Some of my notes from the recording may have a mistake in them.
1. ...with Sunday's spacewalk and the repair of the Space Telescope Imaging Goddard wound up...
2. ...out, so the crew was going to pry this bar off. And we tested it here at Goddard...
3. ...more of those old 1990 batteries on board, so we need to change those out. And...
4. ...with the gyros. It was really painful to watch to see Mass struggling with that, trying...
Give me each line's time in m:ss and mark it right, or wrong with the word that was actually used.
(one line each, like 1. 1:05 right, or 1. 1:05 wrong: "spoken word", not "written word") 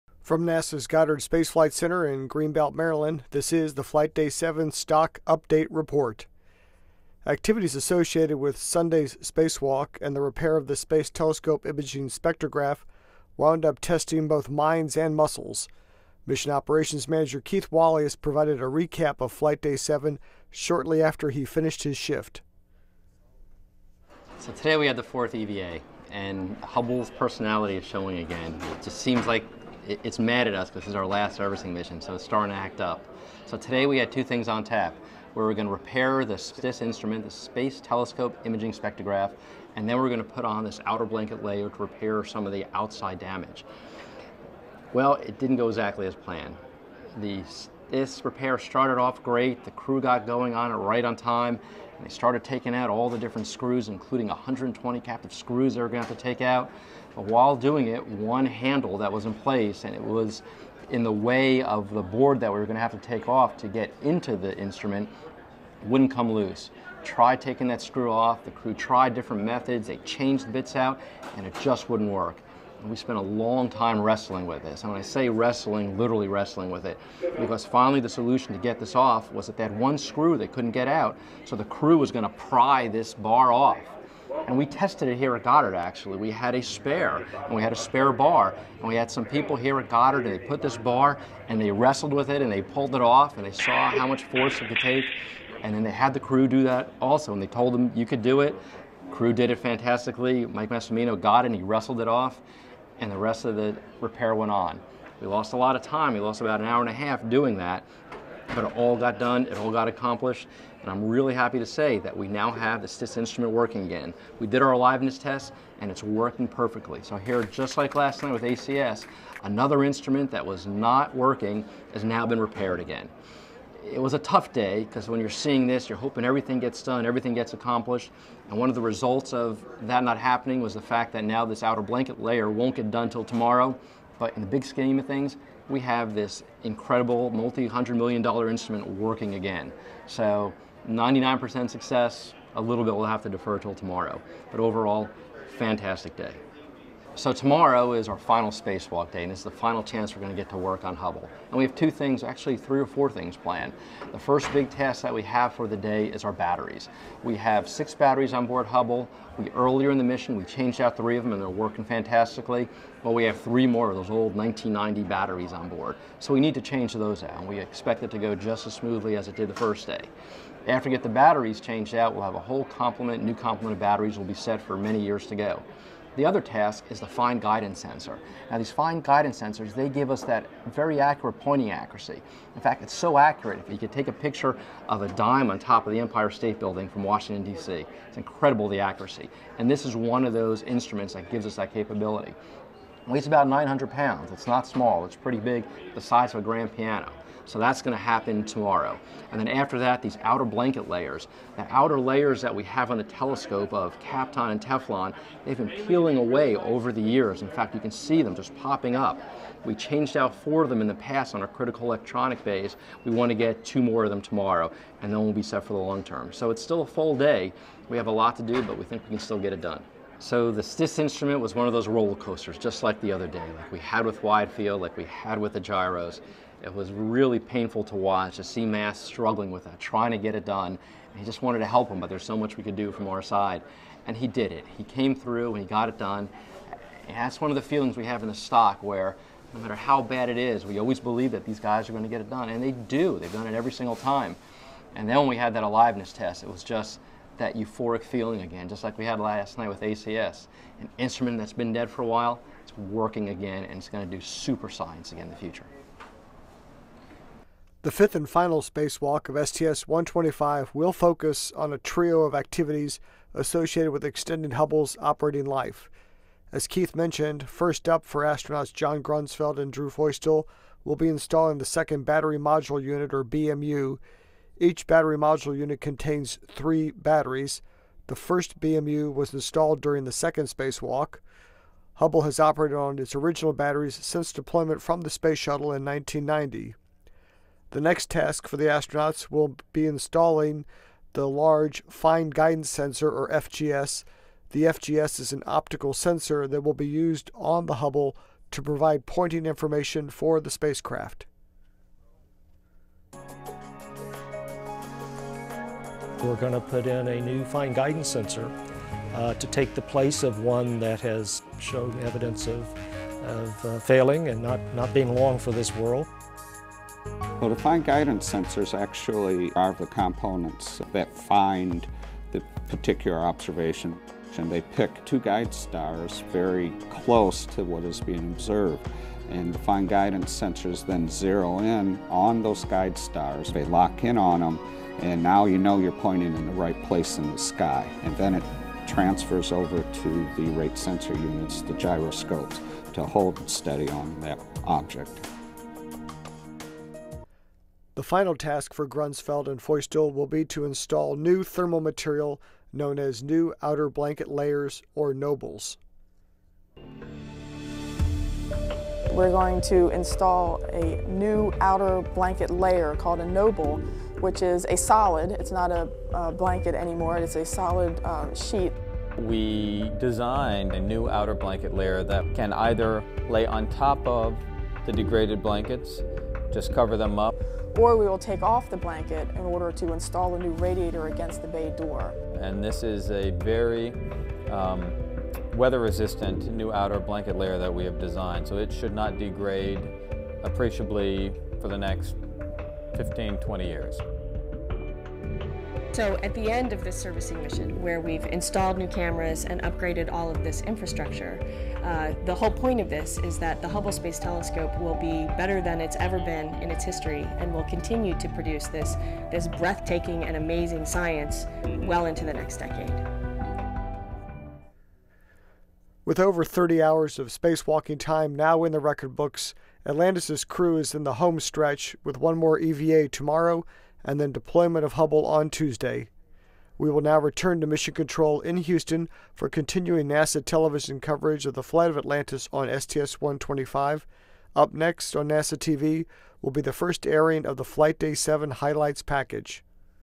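1. 0:08 wrong: "Spectrograph", not "Goddard"
2. 1:20 right
3. 2:43 right
4. 3:45 right.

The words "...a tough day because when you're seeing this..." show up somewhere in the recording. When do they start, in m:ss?
2:04.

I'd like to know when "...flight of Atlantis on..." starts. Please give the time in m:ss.
7:11.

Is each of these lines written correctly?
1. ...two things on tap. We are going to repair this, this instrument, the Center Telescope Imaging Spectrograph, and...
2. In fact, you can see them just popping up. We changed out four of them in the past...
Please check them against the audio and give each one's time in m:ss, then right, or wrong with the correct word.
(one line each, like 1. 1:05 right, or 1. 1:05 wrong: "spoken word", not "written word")
1. 0:34 wrong: "Space", not "Center"
2. 3:27 right.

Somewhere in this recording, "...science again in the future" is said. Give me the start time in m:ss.
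4:14.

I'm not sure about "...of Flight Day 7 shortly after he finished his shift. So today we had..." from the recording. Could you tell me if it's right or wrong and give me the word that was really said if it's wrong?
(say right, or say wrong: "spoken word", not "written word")
right.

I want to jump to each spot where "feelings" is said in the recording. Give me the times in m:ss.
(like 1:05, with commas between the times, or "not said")
3:57, 4:08.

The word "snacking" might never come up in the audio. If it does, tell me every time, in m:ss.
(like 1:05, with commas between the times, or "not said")
not said.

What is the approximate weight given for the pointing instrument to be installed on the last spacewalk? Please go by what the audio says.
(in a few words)
900 pounds.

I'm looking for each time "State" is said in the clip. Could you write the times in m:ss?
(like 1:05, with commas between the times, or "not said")
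3:06.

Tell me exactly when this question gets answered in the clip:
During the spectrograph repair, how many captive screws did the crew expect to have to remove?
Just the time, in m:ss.
0:54.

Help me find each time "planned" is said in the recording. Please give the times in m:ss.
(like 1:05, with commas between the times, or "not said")
0:46, 2:33.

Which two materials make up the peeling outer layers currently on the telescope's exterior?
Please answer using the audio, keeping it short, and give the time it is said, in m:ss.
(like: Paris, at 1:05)
Kapton and Teflon, at 3:23.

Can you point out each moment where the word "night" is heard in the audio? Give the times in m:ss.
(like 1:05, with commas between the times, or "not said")
1:58, 4:09.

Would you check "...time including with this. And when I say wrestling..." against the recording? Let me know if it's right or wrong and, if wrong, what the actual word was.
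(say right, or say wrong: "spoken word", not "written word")
wrong: "wrestling", not "including".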